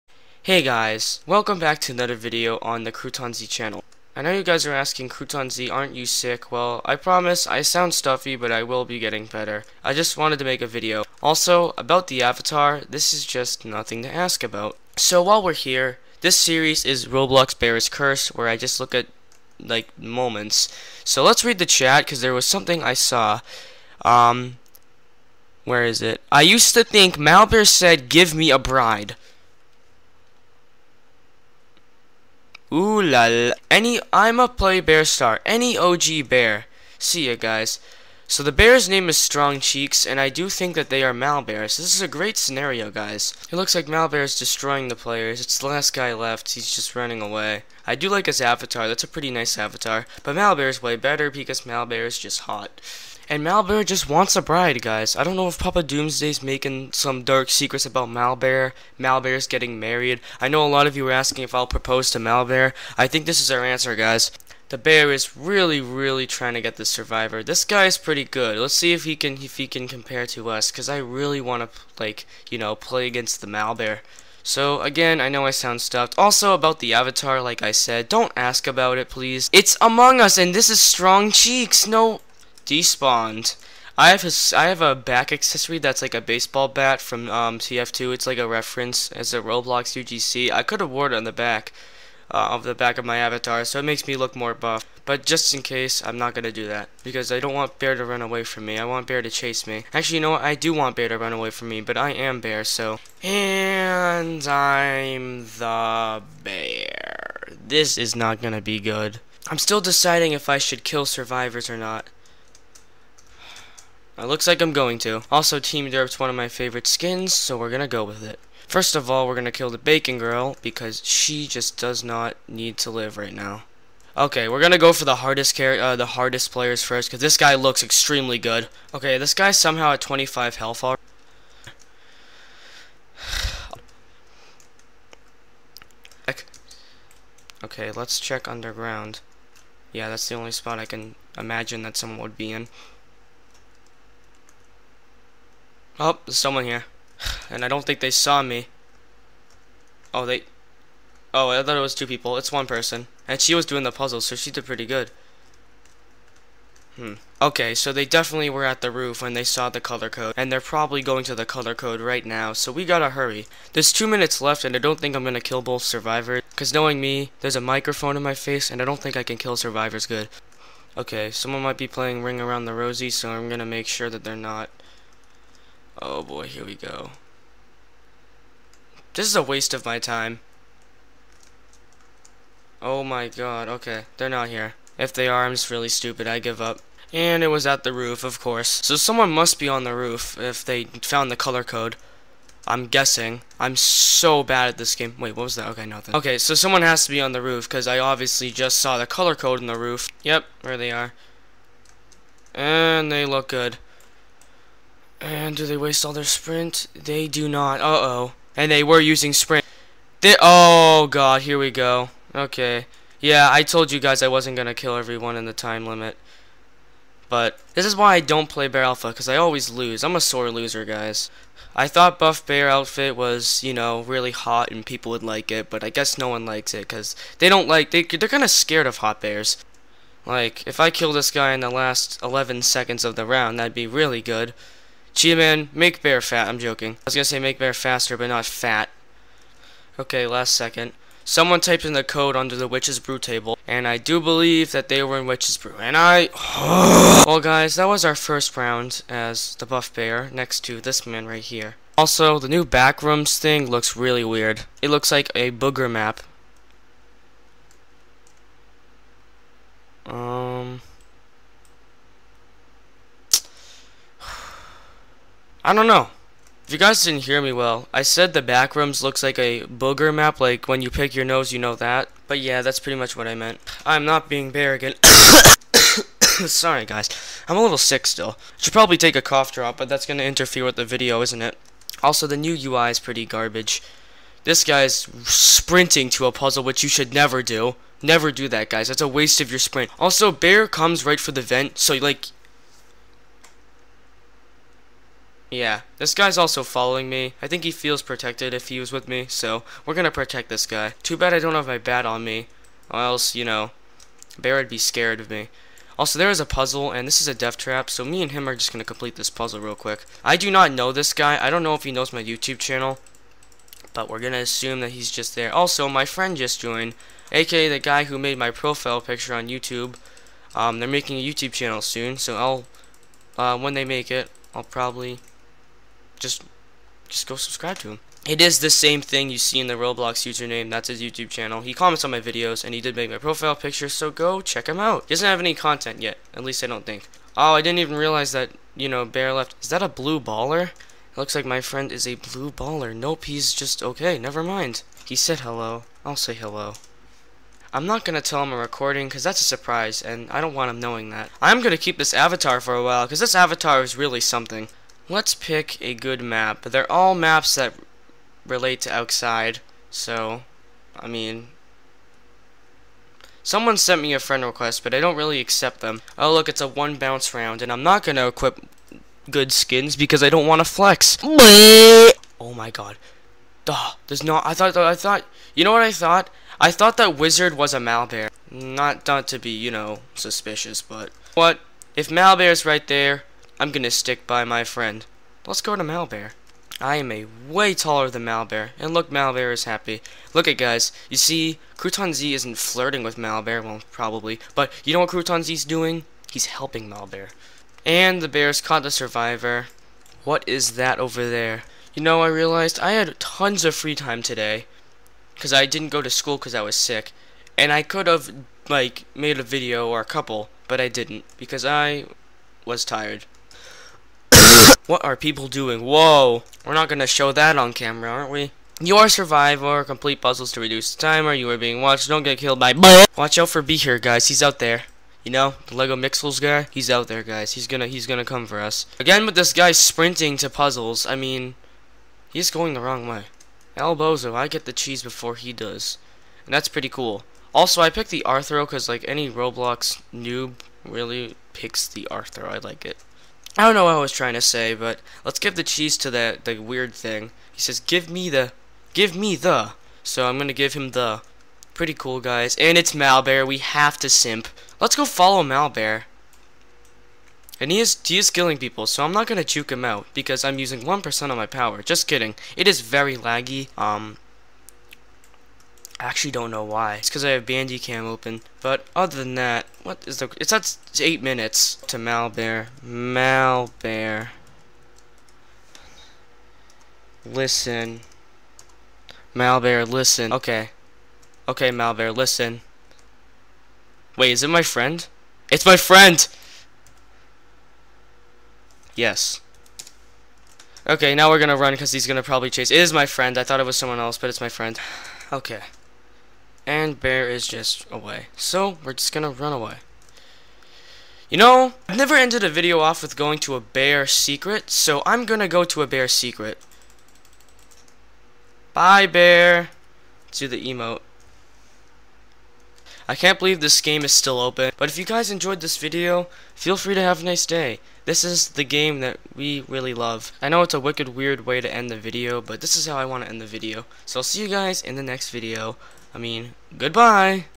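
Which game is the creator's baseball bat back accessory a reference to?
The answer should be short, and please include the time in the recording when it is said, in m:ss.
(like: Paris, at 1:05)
TF2, at 1:27.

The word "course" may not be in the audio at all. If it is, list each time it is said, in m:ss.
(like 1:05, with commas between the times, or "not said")
3:08.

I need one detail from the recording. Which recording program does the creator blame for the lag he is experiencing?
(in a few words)
Bandicam.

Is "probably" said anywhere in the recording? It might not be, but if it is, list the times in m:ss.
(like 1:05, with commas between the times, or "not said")
2:40, 4:38, 5:24, 6:33, 8:12.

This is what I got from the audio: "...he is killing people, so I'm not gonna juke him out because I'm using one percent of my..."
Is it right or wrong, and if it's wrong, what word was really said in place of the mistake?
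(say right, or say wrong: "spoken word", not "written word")
right.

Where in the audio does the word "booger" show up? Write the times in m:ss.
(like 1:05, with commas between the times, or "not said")
4:15, 4:29.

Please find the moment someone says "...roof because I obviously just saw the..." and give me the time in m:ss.
3:17.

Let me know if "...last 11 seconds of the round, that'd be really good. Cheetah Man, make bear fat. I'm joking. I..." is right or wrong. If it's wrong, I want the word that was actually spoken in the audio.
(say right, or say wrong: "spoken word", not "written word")
right.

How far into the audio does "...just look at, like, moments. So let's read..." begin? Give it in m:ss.
0:18.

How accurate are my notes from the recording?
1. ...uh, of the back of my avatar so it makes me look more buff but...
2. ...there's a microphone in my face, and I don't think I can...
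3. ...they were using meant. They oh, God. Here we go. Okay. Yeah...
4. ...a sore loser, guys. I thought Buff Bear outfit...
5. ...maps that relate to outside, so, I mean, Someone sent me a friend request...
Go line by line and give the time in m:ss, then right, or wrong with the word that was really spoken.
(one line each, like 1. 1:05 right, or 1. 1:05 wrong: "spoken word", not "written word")
1. 1:32 right
2. 2:47 right
3. 3:28 wrong: "sprint", not "meant"
4. 3:40 right
5. 5:57 right.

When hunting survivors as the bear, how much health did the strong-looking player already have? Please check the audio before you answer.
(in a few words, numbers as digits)
25.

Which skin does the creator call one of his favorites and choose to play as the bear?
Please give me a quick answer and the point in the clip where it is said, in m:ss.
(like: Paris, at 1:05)
Team Derp, at 1:55.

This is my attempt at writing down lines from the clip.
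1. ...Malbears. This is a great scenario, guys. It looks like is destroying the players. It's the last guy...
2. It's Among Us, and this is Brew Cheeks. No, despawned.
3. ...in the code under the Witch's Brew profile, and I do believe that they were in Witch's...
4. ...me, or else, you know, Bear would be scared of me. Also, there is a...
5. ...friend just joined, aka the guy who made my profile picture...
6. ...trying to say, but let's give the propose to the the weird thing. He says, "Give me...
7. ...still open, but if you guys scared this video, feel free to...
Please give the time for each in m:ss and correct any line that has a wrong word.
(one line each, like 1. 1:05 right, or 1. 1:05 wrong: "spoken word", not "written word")
1. 0:41 right
2. 1:19 wrong: "Strong", not "Brew"
3. 4:01 wrong: "table", not "profile"
4. 5:02 right
5. 5:16 right
6. 7:24 wrong: "cheese", not "propose"
7. 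8:34 wrong: "enjoyed", not "scared".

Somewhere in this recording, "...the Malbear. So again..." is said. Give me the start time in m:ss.
1:13.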